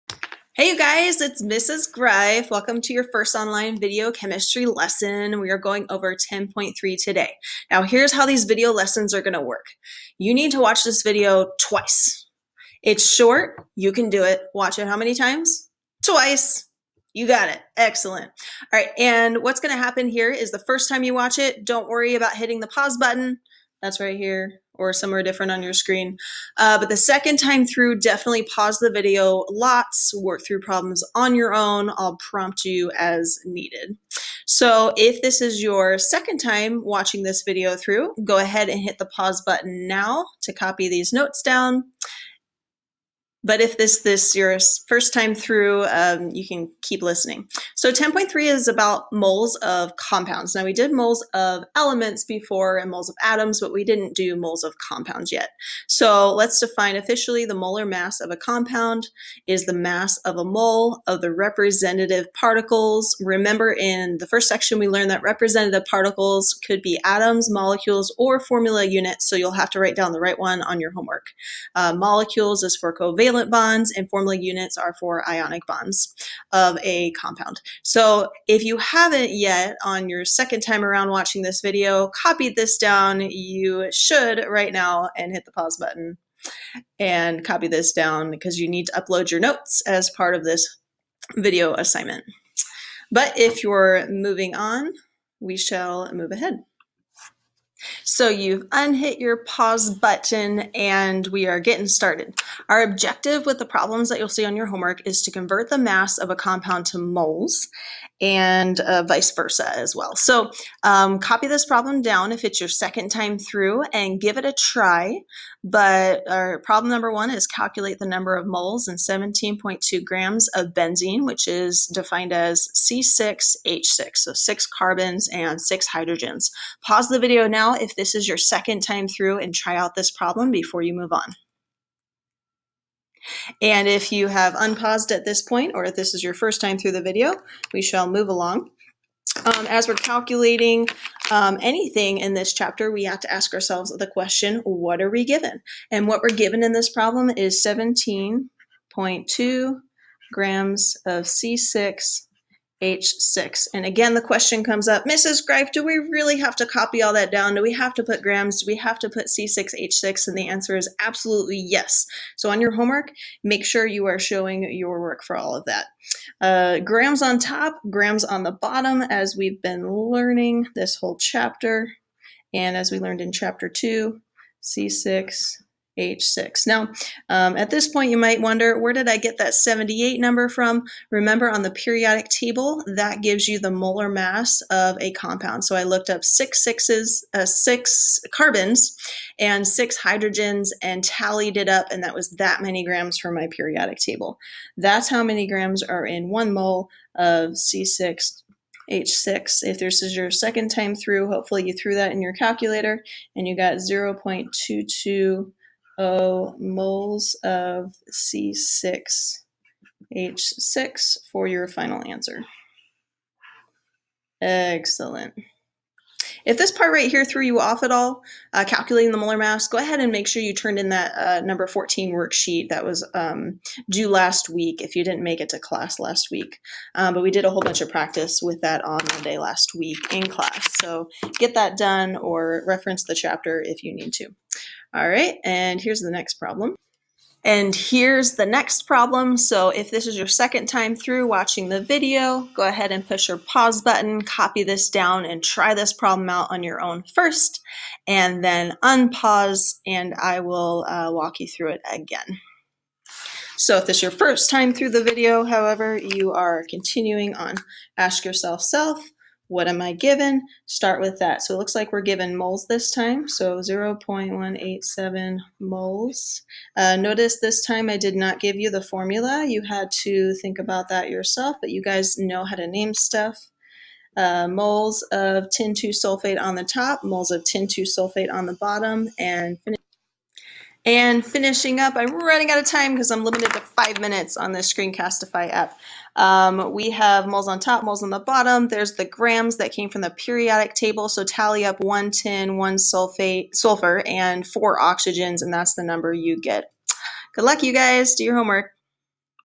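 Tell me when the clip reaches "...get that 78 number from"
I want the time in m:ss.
2:59.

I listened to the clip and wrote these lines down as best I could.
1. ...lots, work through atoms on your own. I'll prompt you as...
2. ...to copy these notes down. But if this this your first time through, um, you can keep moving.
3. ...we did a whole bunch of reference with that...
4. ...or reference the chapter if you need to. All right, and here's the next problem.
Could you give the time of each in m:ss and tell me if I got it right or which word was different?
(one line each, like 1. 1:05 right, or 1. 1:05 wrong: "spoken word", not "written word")
1. 0:29 wrong: "problems", not "atoms"
2. 0:40 wrong: "listening", not "moving"
3. 3:47 wrong: "practice", not "reference"
4. 3:52 right.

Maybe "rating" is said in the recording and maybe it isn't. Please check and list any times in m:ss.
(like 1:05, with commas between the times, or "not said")
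not said.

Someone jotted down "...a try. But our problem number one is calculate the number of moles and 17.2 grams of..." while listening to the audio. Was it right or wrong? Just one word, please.
right.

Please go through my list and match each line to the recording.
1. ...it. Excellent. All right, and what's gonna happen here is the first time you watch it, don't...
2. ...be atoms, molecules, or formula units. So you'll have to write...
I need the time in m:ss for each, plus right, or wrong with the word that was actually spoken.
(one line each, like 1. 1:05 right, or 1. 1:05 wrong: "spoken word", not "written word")
1. 0:17 right
2. 1:06 right.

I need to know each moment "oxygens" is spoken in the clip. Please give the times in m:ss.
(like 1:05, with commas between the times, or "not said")
4:54.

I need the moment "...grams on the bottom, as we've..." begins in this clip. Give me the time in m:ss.
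2:47.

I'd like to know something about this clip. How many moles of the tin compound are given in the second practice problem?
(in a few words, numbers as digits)
0.187 moles.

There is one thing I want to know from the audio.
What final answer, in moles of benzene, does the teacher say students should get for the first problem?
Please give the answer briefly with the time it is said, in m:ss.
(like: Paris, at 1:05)
0.220 moles, at 3:23.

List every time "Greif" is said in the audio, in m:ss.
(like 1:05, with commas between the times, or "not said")
0:01, 2:35.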